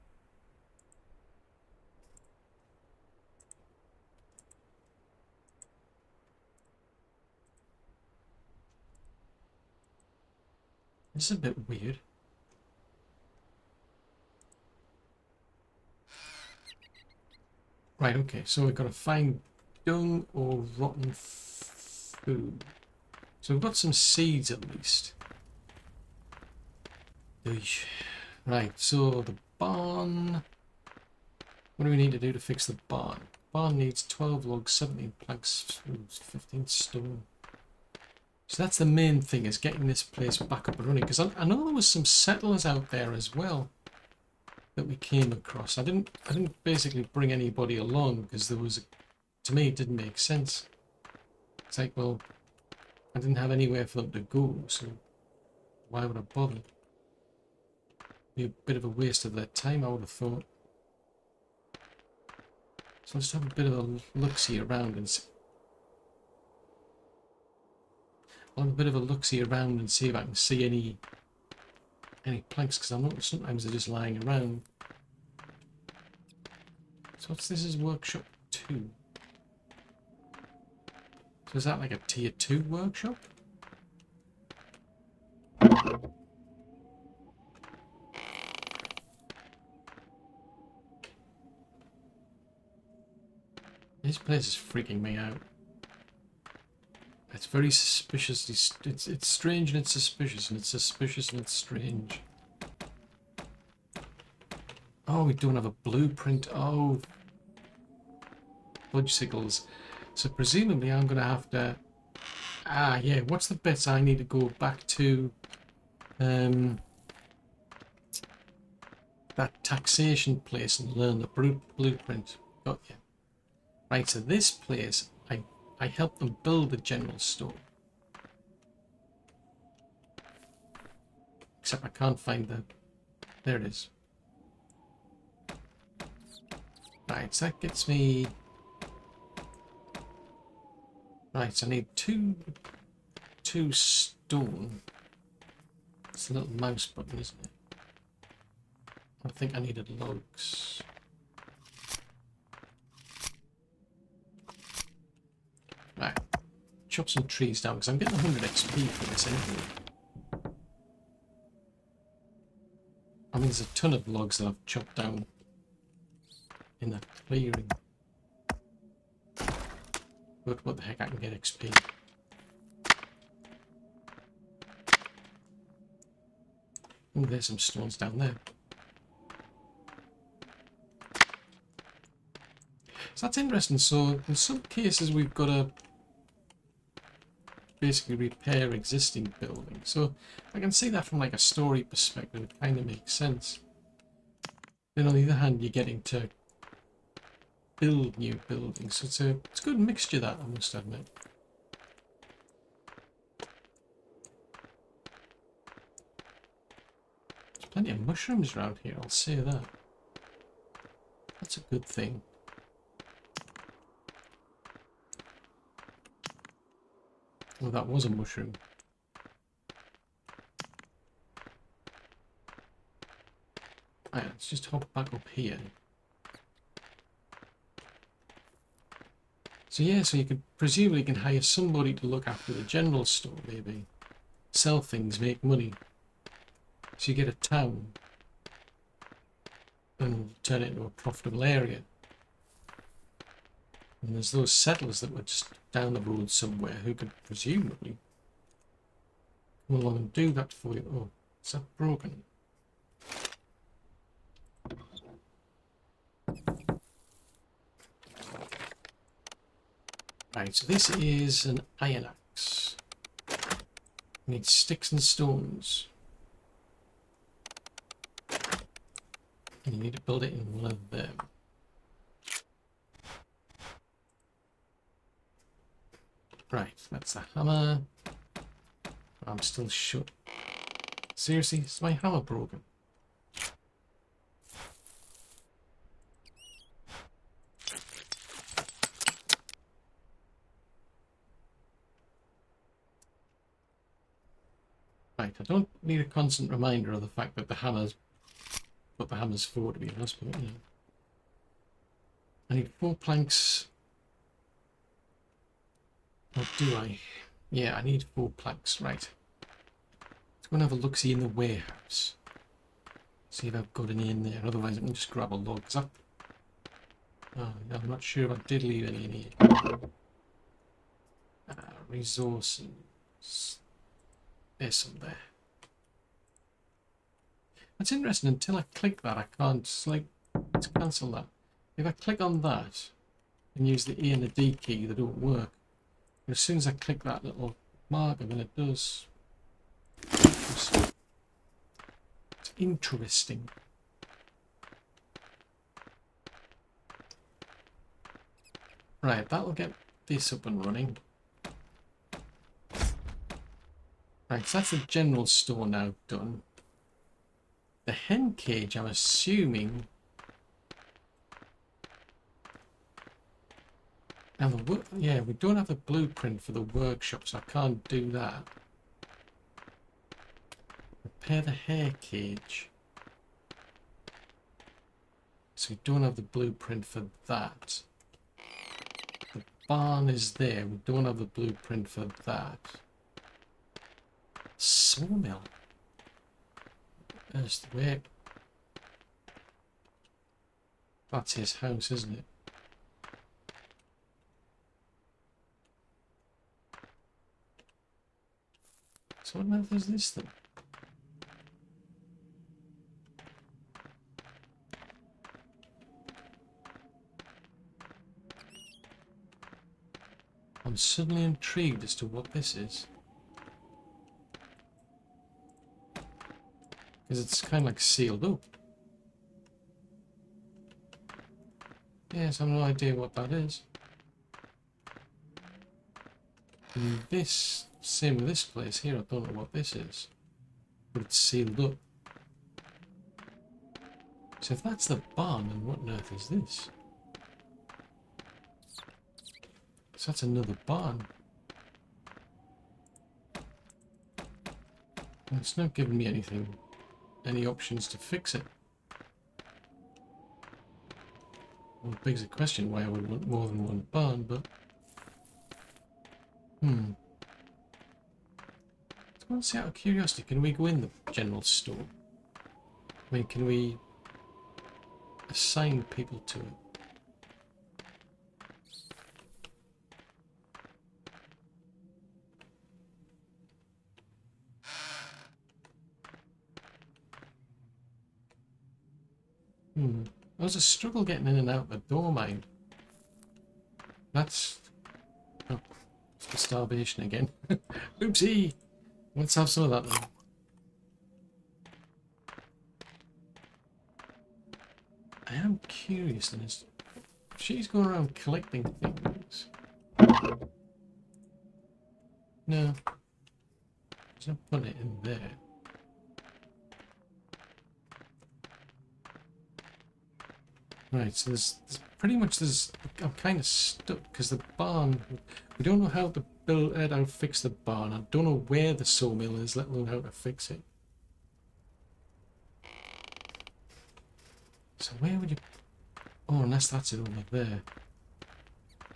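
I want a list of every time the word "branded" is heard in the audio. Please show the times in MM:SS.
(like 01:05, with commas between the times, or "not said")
not said.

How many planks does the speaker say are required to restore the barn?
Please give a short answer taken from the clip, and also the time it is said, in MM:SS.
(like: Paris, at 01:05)
17, at 00:34.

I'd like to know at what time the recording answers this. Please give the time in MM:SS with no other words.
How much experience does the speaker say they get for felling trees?
02:38.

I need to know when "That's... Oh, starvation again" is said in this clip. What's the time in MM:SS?
08:04.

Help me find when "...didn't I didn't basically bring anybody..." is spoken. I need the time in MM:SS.
00:45.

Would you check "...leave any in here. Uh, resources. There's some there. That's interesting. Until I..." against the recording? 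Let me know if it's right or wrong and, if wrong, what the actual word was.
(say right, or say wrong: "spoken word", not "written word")
right.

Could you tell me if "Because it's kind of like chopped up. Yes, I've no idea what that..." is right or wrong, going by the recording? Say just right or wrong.
wrong.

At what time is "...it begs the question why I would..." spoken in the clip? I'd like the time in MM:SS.
07:31.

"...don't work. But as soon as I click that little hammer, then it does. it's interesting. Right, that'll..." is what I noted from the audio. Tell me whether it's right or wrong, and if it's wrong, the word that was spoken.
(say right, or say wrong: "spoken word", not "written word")
wrong: "marker", not "hammer".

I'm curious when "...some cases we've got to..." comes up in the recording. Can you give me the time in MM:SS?
03:04.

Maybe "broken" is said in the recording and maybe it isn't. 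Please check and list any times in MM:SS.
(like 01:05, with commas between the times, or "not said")
04:11, 04:42.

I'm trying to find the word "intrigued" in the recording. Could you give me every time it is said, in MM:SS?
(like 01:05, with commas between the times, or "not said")
06:51.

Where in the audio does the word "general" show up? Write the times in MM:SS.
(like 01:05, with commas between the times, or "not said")
02:06, 03:52, 05:54, 07:41.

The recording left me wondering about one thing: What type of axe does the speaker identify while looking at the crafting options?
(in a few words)
Iron axe.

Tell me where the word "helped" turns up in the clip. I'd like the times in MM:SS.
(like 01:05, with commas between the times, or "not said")
02:05.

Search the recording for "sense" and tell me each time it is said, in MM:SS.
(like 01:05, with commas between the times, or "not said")
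00:50, 03:13.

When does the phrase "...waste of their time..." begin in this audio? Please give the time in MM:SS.
00:58.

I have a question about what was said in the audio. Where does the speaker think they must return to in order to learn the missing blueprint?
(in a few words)
Taxation place.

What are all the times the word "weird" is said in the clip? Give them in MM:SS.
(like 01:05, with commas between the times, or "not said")
00:11.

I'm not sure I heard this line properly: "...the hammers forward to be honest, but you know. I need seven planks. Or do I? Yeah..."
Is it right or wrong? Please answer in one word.
wrong.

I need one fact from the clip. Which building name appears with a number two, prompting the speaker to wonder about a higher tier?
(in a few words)
Workshop 2.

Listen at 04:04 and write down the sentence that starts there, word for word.
And there's those settlers that were just down the road somewhere who could presumably come along and do that for you.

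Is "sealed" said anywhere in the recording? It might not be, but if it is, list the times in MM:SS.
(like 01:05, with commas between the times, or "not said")
06:57, 07:11.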